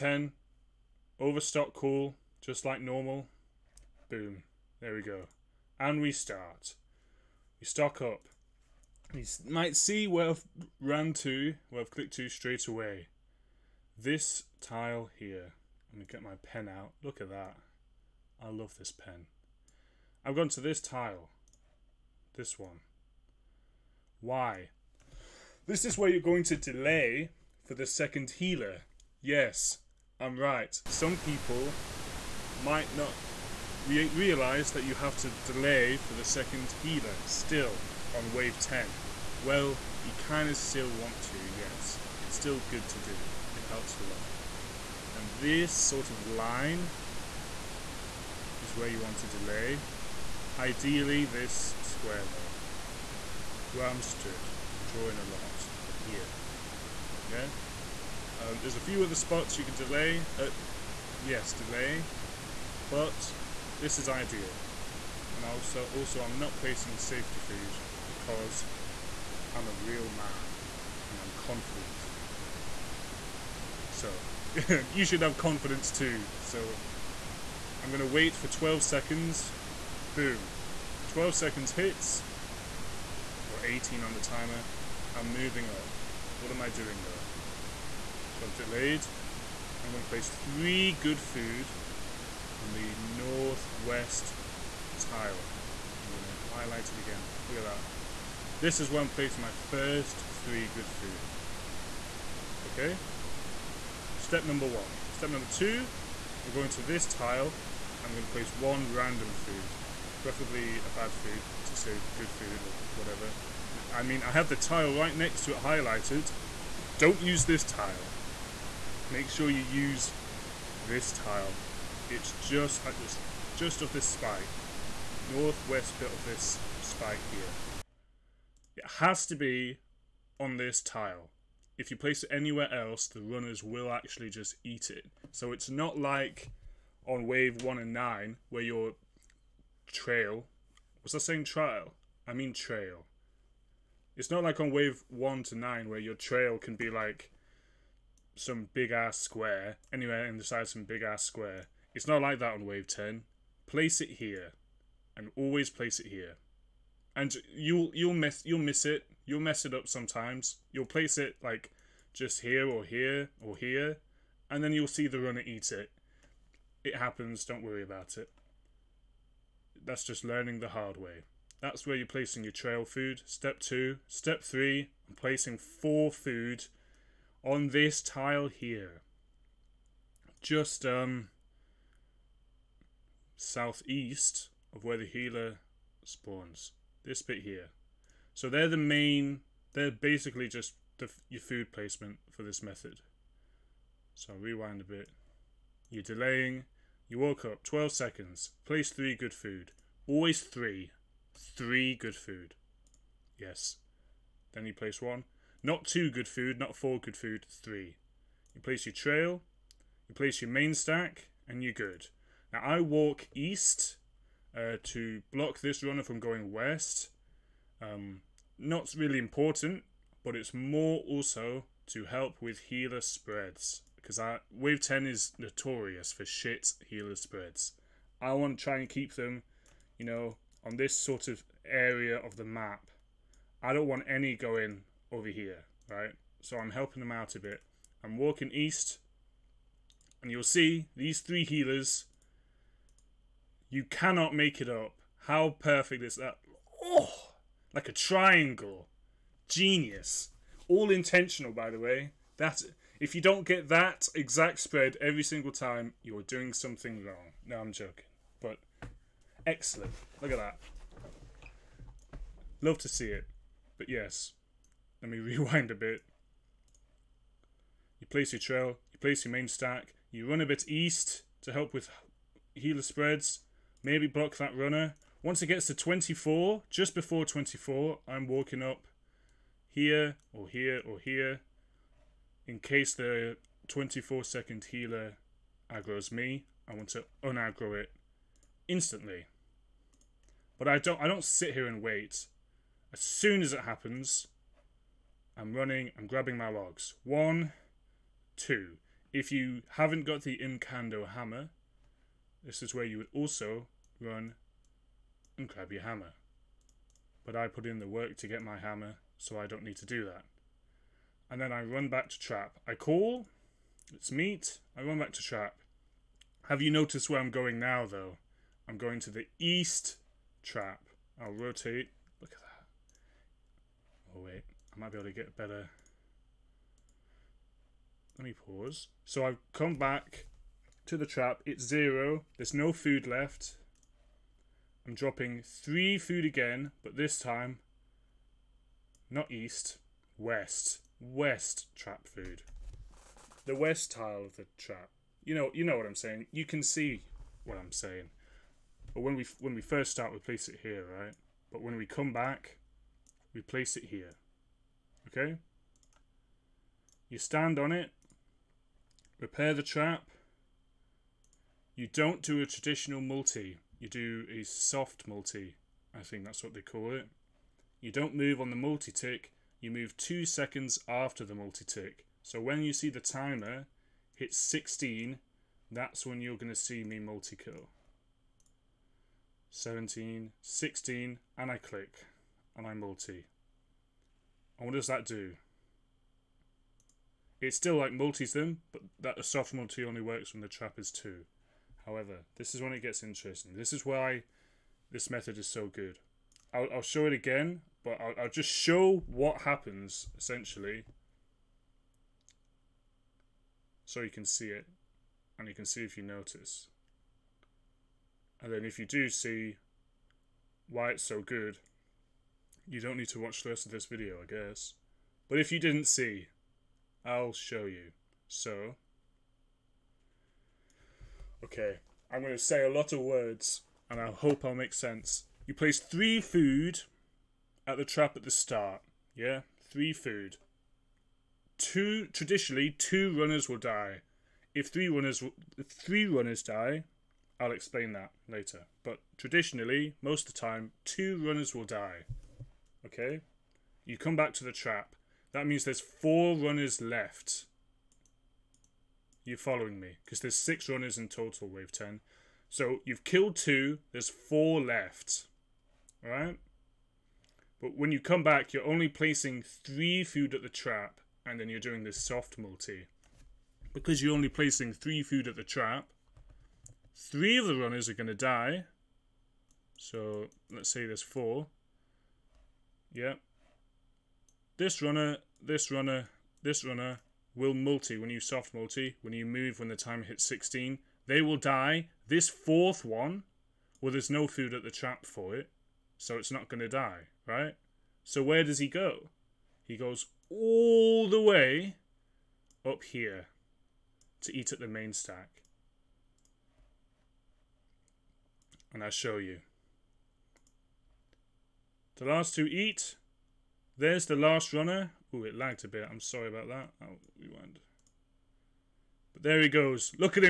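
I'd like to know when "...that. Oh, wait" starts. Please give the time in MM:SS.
05:22.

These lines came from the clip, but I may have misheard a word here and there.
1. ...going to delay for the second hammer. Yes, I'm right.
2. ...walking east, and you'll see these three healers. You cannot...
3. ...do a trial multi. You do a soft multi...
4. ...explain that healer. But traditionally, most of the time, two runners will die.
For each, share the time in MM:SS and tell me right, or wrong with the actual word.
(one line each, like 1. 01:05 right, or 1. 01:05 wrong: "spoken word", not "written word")
1. 00:26 wrong: "healer", not "hammer"
2. 03:58 right
3. 06:02 wrong: "traditional", not "trial"
4. 07:17 wrong: "later", not "healer".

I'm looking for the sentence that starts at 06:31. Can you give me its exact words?
However, this is when it gets interesting.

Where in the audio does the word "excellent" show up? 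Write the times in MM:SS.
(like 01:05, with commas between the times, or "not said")
04:19.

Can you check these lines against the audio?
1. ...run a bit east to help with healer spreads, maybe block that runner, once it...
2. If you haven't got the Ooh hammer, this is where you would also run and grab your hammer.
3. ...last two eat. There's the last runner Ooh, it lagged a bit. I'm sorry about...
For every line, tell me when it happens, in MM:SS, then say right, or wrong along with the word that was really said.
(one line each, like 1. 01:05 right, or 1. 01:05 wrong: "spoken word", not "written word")
1. 04:30 right
2. 04:59 wrong: "Imcando", not "Ooh"
3. 08:22 right.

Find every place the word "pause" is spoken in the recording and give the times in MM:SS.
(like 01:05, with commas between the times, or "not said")
05:28.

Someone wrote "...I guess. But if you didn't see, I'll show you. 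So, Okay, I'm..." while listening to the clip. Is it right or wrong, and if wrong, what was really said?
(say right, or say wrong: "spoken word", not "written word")
right.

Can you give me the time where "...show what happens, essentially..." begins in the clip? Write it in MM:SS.
06:38.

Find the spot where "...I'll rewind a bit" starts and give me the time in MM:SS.
03:14.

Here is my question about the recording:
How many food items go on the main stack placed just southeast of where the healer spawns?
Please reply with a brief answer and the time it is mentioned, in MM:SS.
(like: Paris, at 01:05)
4, at 02:55.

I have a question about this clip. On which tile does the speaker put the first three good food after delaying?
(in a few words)
northwest tile.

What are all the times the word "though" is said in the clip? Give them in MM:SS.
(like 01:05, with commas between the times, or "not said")
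00:52, 01:27, 05:17.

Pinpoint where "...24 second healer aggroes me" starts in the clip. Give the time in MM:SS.
04:43.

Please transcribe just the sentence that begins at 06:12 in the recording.
So when you see the timer hit 16, that's when you're going to see me multi kill.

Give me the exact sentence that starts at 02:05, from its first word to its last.
Northwest bit of this spike here.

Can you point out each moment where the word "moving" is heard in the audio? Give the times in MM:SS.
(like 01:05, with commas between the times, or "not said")
01:25.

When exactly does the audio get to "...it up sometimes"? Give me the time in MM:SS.
02:39.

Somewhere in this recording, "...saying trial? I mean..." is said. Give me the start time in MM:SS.
02:21.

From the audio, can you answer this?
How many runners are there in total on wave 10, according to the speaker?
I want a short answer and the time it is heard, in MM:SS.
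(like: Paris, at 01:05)
6, at 07:30.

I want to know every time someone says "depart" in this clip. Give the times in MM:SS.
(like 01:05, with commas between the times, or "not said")
not said.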